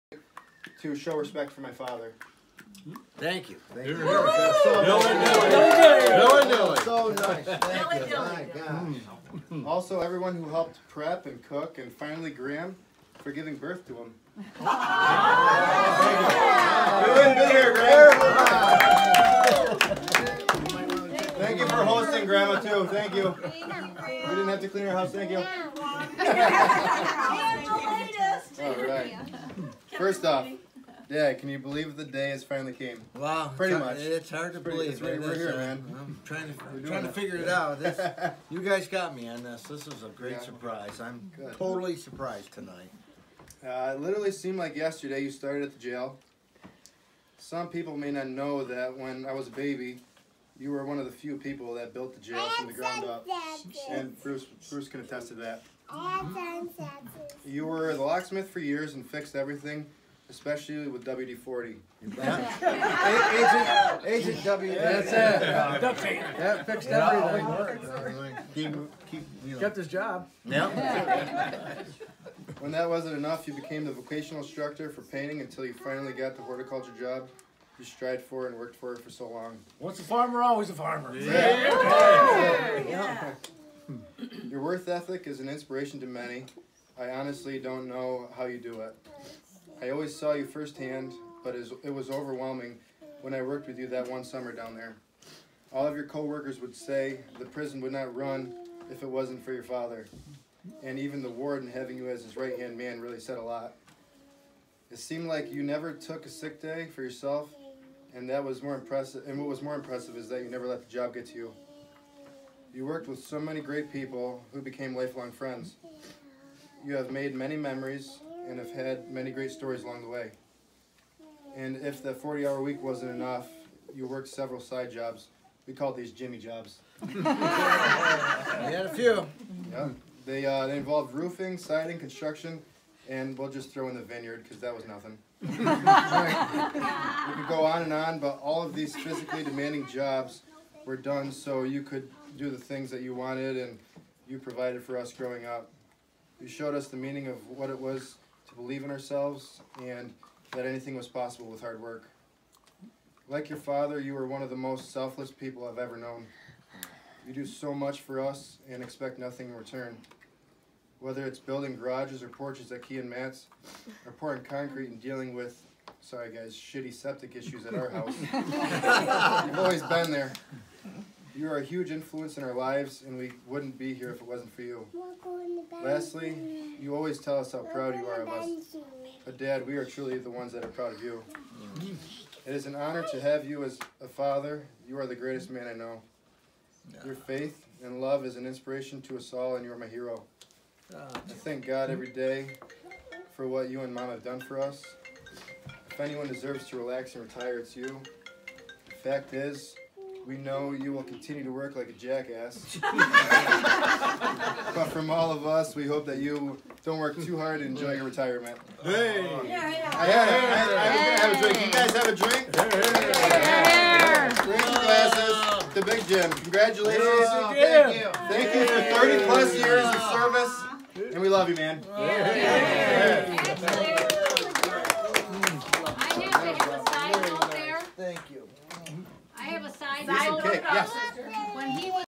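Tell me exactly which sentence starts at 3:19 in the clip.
The fact is, we know you will continue to work like a jackass.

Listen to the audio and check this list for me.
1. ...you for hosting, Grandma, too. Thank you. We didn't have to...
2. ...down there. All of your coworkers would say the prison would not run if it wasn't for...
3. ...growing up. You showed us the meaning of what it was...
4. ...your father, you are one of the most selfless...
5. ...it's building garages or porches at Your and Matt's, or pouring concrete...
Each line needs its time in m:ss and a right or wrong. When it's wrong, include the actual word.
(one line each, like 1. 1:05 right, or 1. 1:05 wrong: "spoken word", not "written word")
1. 0:21 right
2. 1:34 right
3. 2:25 right
4. 2:33 right
5. 2:41 wrong: "Key", not "Your".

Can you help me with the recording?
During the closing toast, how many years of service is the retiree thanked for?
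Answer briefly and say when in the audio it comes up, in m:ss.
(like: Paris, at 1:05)
30 plus, at 3:39.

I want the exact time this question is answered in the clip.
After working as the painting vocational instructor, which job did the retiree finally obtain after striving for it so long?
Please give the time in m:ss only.
1:16.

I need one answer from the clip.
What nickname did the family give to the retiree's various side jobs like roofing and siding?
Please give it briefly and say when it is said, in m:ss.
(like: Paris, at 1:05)
Jimmy jobs, at 2:06.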